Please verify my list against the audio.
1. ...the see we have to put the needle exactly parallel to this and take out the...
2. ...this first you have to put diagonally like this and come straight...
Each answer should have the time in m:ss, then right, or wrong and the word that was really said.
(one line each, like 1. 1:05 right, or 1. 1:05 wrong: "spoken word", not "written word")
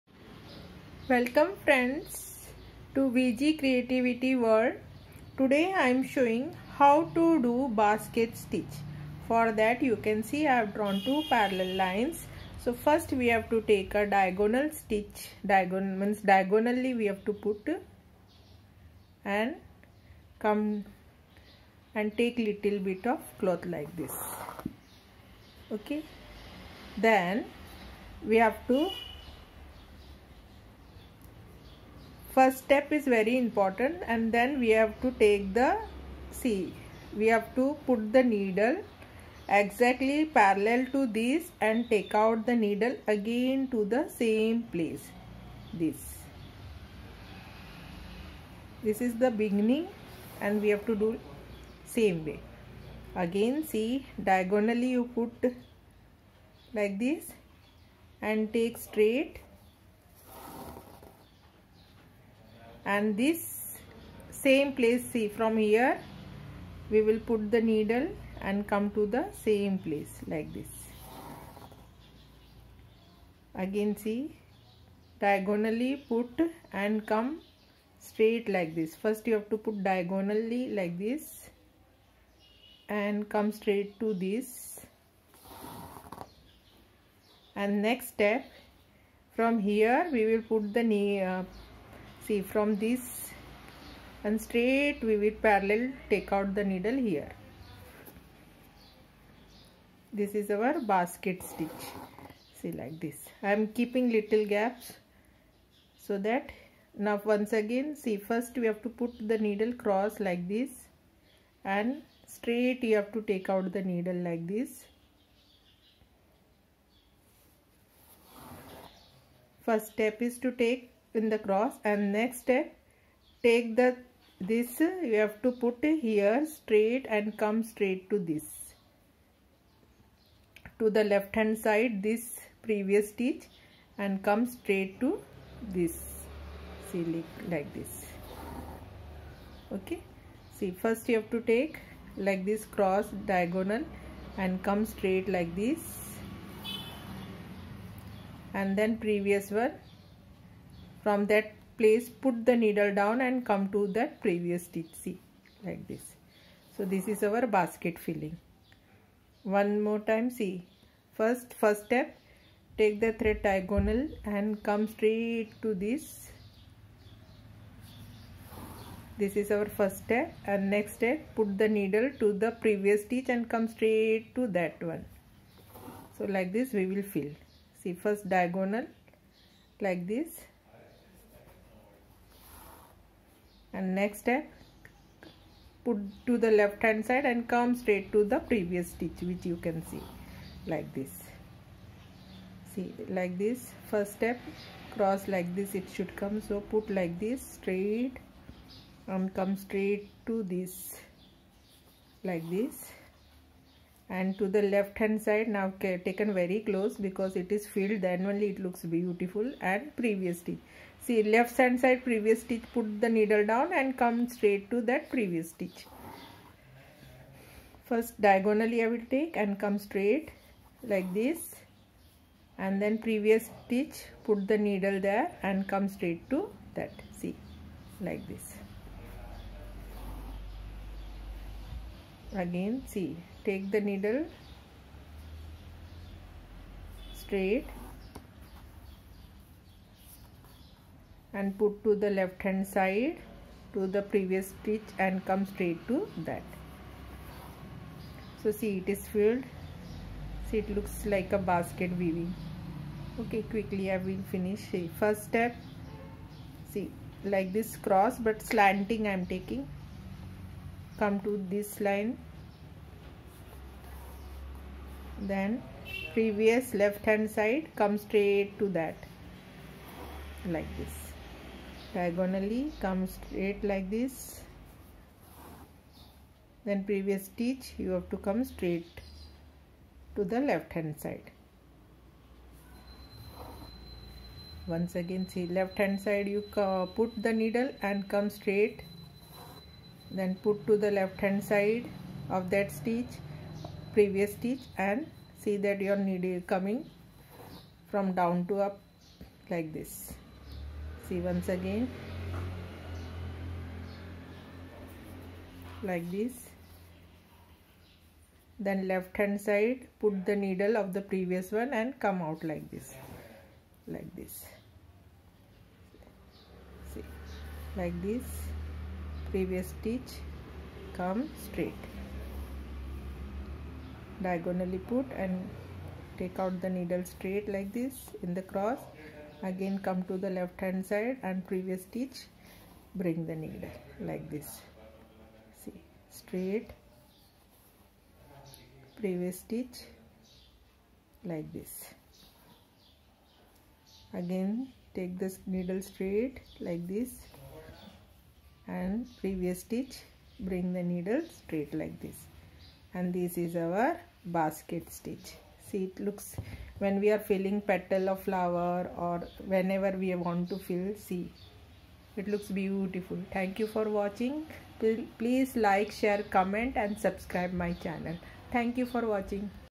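1. 0:35 right
2. 1:18 right.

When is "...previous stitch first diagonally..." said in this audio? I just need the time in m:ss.
3:35.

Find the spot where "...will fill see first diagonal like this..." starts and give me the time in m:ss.
2:56.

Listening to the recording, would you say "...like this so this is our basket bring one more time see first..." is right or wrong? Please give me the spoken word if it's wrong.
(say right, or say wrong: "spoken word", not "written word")
wrong: "filling", not "bring".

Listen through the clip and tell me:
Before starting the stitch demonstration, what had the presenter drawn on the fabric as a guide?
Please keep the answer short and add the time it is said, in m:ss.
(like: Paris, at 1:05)
Two parallel lines, at 0:11.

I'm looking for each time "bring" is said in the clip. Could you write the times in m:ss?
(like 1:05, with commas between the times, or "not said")
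5:33, 5:50.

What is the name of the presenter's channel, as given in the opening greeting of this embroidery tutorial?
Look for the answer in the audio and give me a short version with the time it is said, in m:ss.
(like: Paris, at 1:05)
VG Creativity World, at 0:03.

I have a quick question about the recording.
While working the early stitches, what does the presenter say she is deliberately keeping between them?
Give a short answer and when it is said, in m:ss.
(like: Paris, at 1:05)
Little gaps, at 1:44.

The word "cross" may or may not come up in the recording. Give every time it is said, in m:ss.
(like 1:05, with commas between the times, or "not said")
1:49, 2:01, 2:22, 3:14, 4:17, 5:28.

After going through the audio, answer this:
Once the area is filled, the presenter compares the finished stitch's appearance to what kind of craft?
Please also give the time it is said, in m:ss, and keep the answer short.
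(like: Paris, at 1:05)
Basket weaving, at 4:11.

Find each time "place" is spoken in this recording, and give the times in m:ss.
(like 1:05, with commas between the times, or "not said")
0:44, 1:04, 1:09, 2:31.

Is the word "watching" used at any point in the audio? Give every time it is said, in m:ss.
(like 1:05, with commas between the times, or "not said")
6:04, 6:09.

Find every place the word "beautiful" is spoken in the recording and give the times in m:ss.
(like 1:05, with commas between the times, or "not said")
3:28, 6:02.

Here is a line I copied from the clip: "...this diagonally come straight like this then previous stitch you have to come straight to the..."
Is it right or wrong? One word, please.
right.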